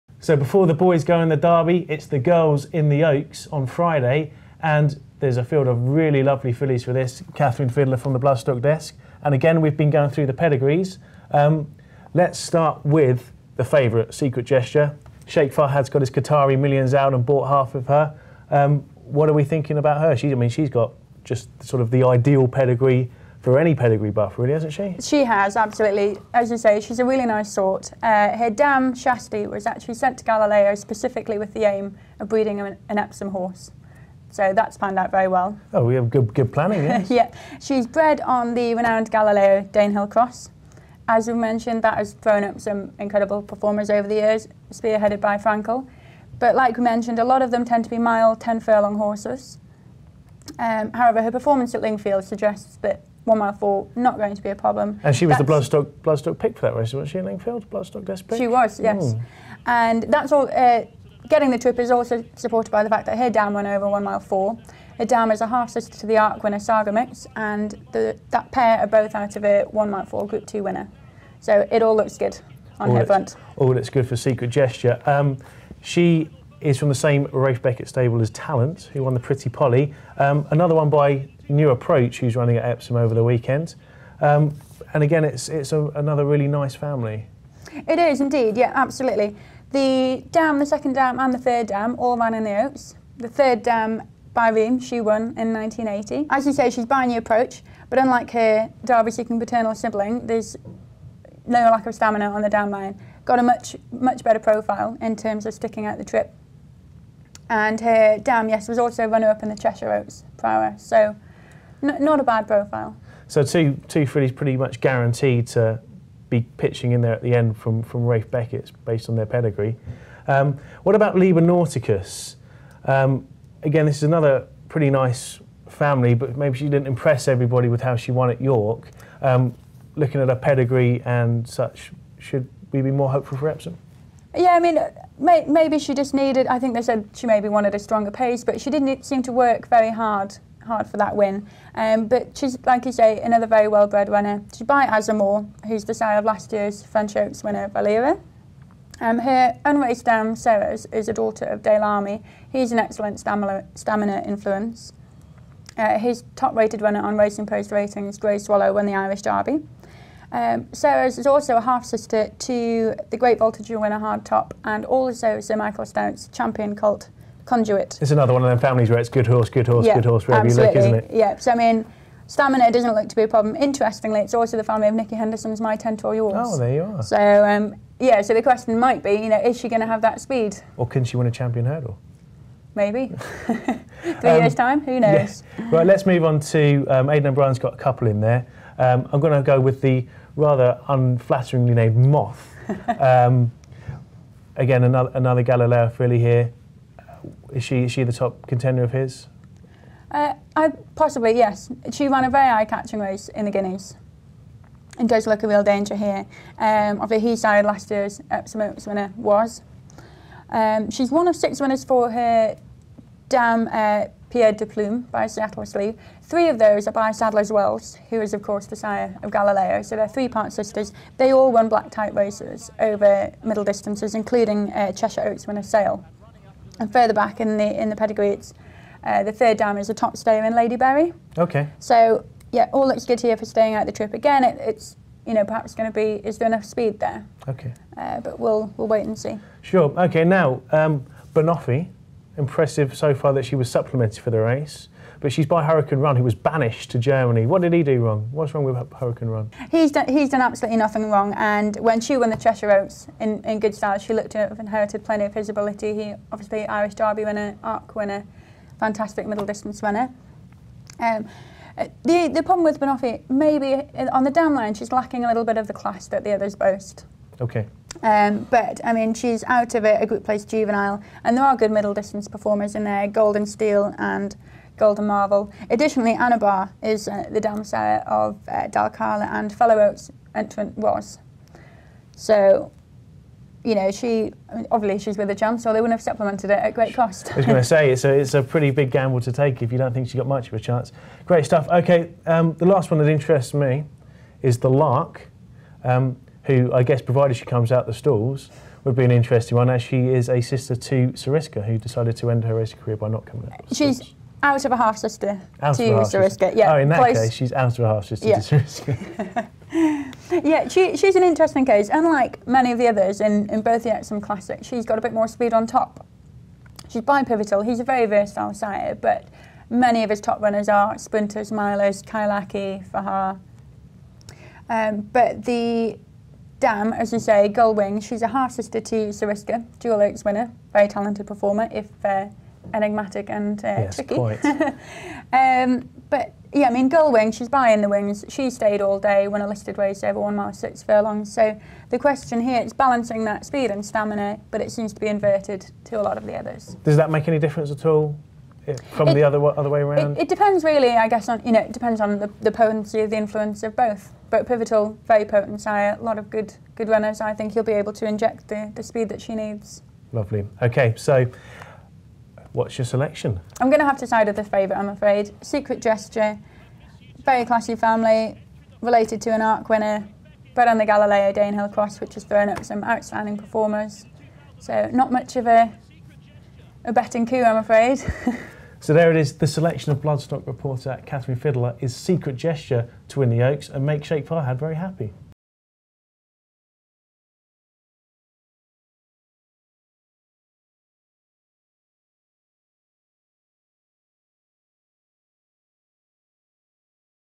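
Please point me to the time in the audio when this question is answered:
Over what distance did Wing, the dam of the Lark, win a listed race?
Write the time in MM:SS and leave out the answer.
05:40.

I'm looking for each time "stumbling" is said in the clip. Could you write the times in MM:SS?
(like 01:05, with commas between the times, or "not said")
not said.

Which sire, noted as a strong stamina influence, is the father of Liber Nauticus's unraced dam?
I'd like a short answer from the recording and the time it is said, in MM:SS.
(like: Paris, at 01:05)
Daylami, at 02:31.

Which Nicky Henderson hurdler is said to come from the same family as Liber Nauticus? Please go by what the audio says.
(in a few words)
My Tent or Yours.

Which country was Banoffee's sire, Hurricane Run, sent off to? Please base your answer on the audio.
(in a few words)
Germany.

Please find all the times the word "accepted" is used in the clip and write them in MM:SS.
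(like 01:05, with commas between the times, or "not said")
not said.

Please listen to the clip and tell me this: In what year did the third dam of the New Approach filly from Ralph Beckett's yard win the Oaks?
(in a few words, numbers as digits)
1980.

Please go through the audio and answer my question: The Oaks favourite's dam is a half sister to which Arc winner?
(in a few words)
Sagamix.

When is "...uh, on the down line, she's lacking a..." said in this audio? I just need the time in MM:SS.
04:23.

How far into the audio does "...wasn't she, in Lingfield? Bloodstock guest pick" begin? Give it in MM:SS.
00:56.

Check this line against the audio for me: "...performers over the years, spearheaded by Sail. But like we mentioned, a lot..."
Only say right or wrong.
wrong.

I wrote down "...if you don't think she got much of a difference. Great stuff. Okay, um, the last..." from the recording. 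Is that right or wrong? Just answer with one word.
wrong.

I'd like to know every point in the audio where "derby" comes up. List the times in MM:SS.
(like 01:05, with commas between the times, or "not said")
00:01, 01:38, 02:39, 04:16.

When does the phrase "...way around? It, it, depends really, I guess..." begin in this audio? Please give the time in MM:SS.
05:49.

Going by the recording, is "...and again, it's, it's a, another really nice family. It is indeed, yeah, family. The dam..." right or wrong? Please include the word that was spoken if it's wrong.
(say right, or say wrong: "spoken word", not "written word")
wrong: "absolutely", not "family".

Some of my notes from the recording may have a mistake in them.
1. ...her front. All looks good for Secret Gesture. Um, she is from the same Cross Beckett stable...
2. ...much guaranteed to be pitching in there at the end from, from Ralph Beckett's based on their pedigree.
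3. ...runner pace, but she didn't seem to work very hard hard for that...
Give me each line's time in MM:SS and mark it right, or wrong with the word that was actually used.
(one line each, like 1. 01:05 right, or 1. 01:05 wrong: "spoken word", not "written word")
1. 01:12 wrong: "Ralph", not "Cross"
2. 01:54 right
3. 02:17 wrong: "stronger", not "runner".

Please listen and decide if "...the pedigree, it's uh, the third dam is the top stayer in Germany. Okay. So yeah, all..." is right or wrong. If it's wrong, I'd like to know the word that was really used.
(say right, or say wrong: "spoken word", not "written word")
wrong: "Barry", not "Germany".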